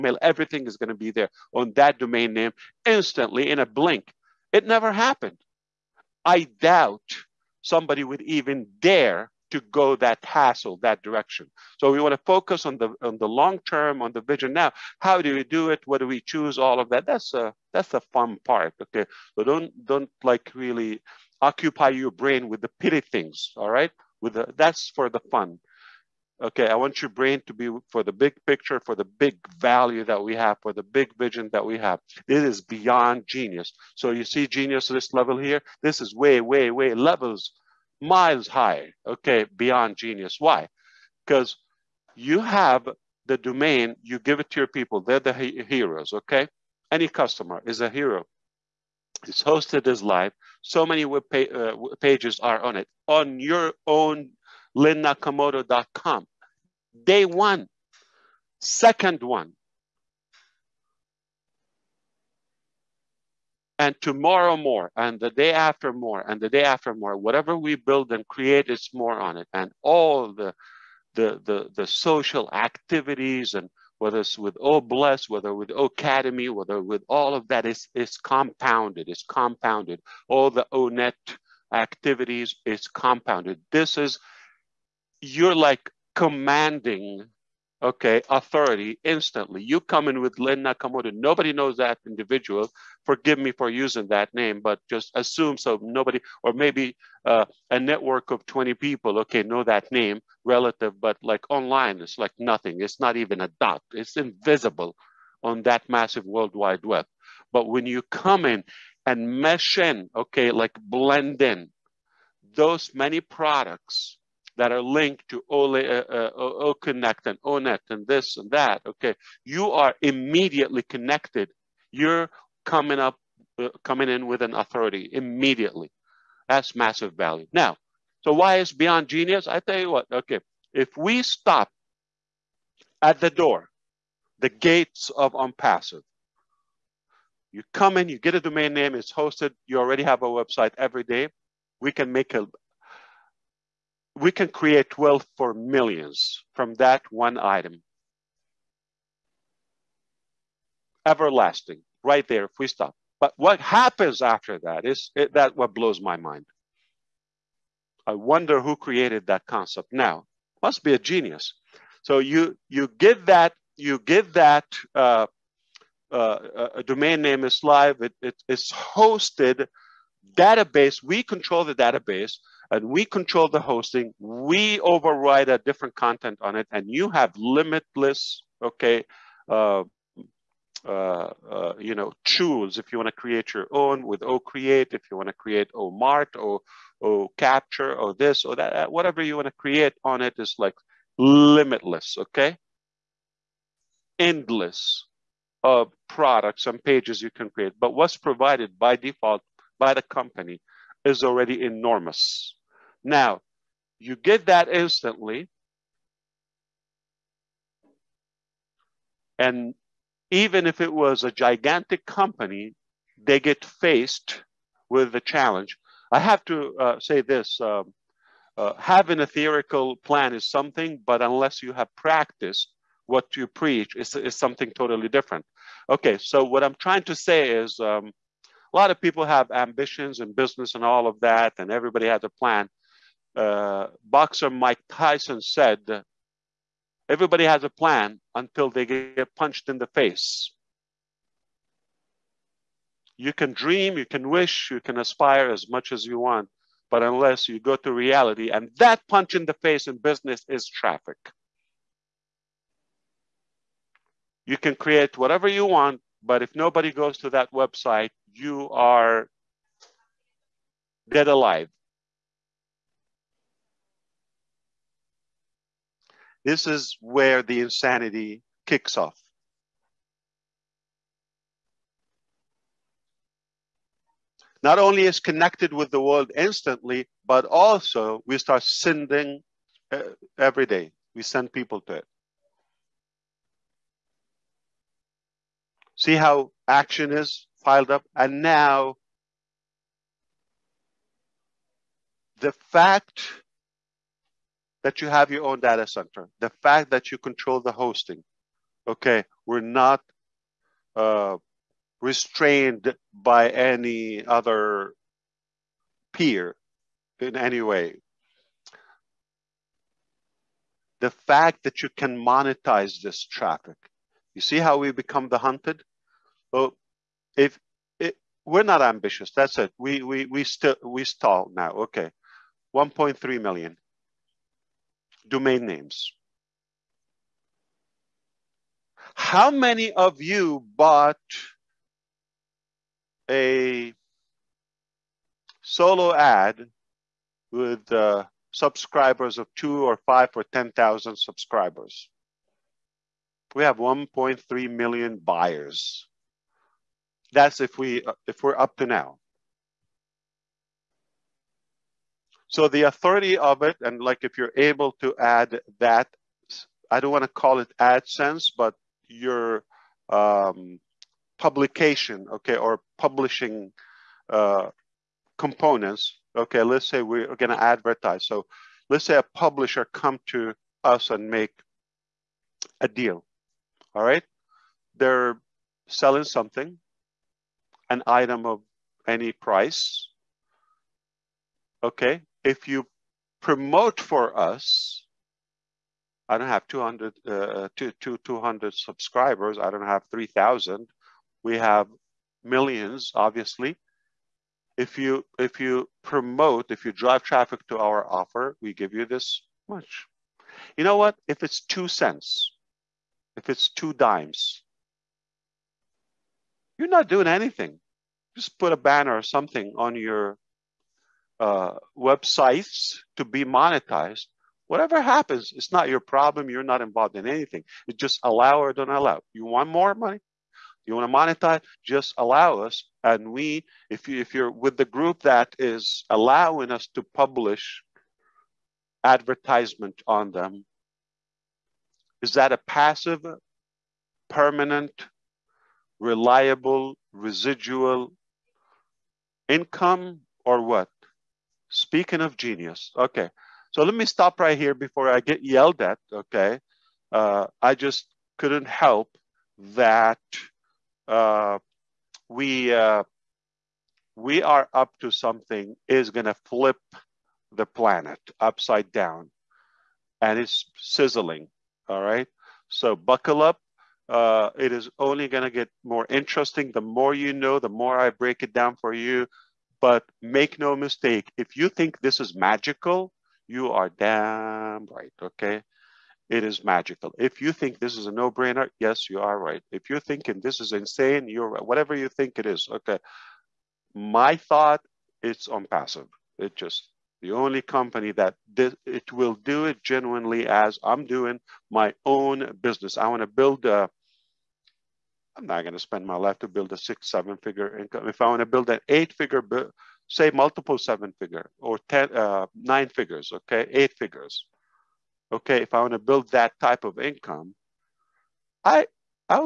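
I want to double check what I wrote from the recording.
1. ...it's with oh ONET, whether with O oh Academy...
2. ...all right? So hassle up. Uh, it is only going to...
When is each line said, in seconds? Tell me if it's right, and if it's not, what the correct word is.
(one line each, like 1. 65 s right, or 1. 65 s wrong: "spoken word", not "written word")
1. 74 s wrong: "Bless", not "ONET"
2. 461 s wrong: "buckle", not "hassle".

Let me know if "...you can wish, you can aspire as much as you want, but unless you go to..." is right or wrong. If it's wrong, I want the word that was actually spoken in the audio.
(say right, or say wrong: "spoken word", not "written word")
right.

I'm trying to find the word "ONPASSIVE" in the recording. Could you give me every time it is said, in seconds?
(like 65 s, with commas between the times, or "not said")
135 s, 485 s.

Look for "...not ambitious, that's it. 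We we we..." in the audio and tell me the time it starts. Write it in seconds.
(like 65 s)
318 s.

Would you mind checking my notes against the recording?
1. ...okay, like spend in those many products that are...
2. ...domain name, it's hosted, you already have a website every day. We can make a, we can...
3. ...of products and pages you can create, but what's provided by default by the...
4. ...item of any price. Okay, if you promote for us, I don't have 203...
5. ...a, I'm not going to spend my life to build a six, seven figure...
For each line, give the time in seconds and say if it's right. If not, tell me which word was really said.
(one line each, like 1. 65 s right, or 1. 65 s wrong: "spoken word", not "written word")
1. 110 s wrong: "blend", not "spend"
2. 138 s right
3. 195 s right
4. 378 s wrong: "200", not "203"
5. 493 s right.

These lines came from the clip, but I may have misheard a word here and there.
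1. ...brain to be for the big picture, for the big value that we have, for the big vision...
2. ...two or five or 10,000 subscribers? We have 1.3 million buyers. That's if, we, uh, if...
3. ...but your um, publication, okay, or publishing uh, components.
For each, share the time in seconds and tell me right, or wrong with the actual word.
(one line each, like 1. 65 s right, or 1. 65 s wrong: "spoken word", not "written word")
1. 27 s right
2. 339 s right
3. 358 s right.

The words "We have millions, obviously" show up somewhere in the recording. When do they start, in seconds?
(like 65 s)
391 s.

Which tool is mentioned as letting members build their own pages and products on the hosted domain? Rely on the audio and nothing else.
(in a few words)
OCreate.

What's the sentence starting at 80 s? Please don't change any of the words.
All the ONET oh activities is compounded.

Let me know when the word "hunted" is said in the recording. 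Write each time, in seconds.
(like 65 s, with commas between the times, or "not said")
315 s.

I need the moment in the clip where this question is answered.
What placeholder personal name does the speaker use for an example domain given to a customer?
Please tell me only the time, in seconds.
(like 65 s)
90 s.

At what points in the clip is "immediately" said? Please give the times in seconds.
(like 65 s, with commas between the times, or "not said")
120 s, 125 s.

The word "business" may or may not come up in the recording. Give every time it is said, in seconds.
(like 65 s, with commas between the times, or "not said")
230 s, 249 s, 492 s.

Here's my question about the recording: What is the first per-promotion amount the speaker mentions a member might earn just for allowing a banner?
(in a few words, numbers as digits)
2 cents.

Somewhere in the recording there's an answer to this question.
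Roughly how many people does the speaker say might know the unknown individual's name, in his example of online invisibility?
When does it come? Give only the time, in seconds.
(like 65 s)
98 s.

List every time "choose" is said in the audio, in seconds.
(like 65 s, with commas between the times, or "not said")
16 s.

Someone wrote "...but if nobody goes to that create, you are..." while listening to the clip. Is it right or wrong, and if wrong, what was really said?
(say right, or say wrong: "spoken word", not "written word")
wrong: "website", not "create".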